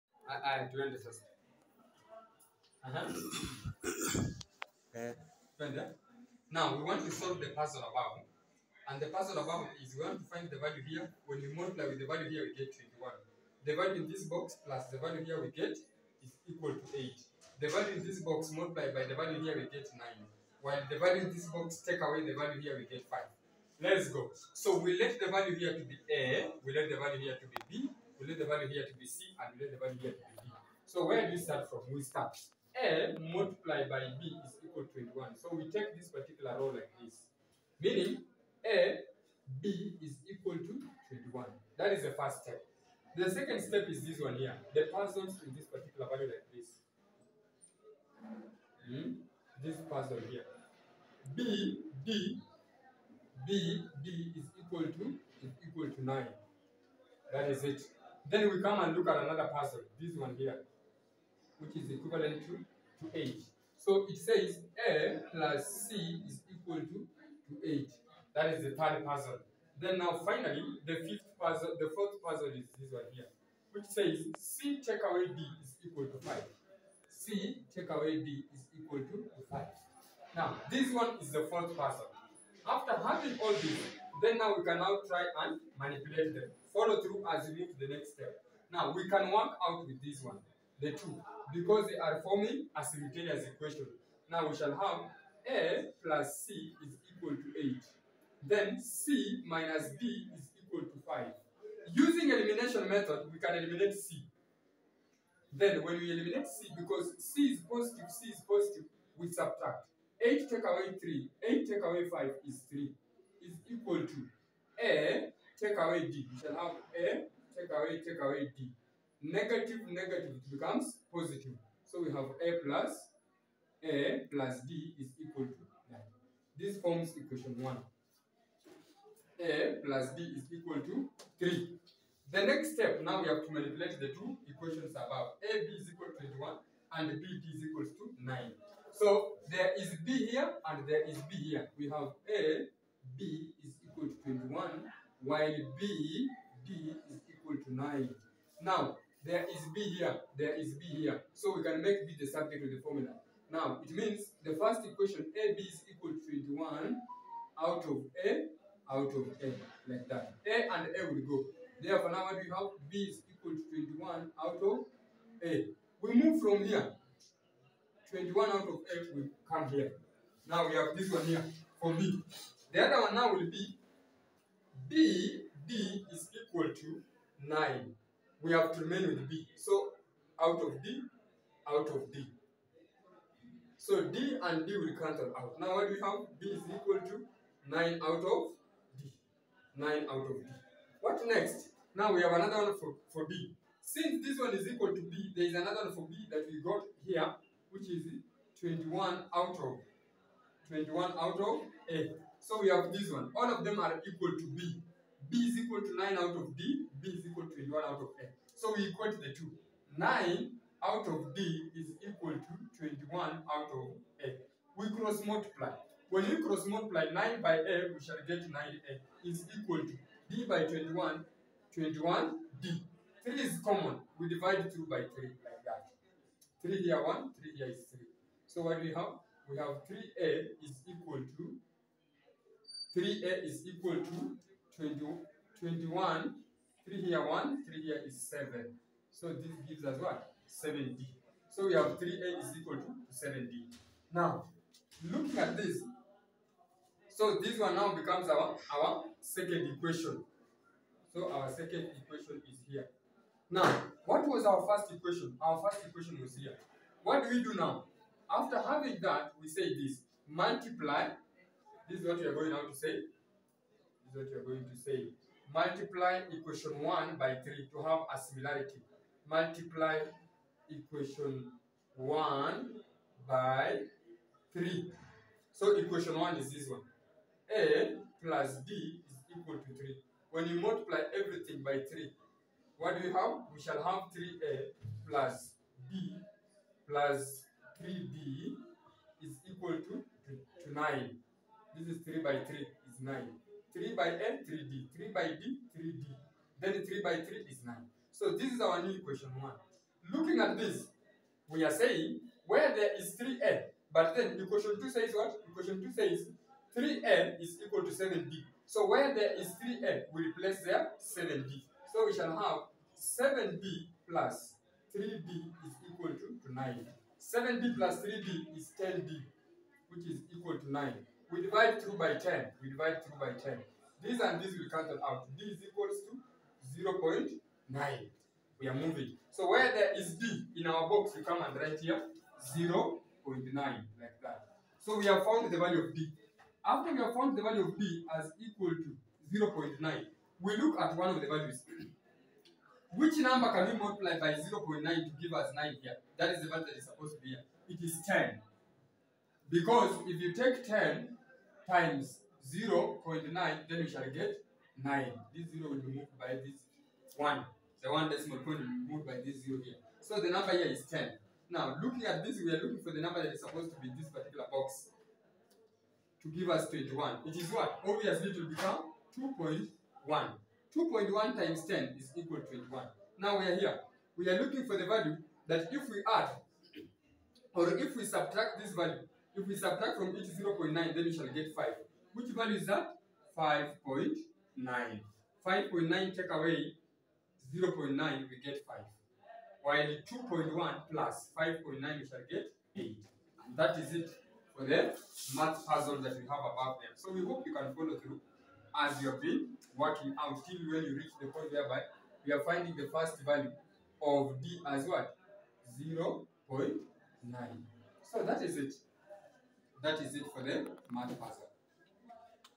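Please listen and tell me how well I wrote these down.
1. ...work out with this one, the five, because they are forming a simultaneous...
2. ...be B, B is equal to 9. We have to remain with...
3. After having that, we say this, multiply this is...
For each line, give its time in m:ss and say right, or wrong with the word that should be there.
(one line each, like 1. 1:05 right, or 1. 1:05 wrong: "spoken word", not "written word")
1. 1:29 wrong: "two", not "five"
2. 2:53 right
3. 4:18 right.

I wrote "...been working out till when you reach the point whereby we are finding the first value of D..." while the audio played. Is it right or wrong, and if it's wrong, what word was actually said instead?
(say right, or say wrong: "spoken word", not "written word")
right.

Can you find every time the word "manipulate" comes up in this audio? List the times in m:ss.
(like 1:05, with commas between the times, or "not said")
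1:25, 2:13.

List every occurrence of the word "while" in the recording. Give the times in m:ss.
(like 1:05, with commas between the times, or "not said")
0:20, 2:25, 6:29.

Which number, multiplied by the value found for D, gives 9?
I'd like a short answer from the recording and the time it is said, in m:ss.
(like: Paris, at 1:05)
10, at 5:47.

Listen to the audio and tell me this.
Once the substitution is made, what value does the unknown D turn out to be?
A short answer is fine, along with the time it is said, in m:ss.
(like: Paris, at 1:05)
0.9, at 5:25.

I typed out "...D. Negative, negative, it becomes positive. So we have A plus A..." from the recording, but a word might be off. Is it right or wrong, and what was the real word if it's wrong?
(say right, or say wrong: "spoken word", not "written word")
right.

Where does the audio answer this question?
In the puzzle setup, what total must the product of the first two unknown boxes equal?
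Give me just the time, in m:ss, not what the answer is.
0:12.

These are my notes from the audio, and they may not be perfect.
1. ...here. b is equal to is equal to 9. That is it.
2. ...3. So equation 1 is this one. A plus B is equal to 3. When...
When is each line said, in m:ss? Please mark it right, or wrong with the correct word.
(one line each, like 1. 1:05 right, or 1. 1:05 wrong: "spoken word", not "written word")
1. 0:50 right
2. 4:34 right.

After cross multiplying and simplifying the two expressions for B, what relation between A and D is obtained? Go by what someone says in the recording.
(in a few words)
3a = 7d.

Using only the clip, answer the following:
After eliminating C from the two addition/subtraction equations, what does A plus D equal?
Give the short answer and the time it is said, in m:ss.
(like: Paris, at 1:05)
3, at 2:09.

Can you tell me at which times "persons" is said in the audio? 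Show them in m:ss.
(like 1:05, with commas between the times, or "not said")
0:44, 0:49.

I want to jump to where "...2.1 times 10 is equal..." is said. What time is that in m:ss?
6:10.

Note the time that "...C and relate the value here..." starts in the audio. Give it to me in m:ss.
0:29.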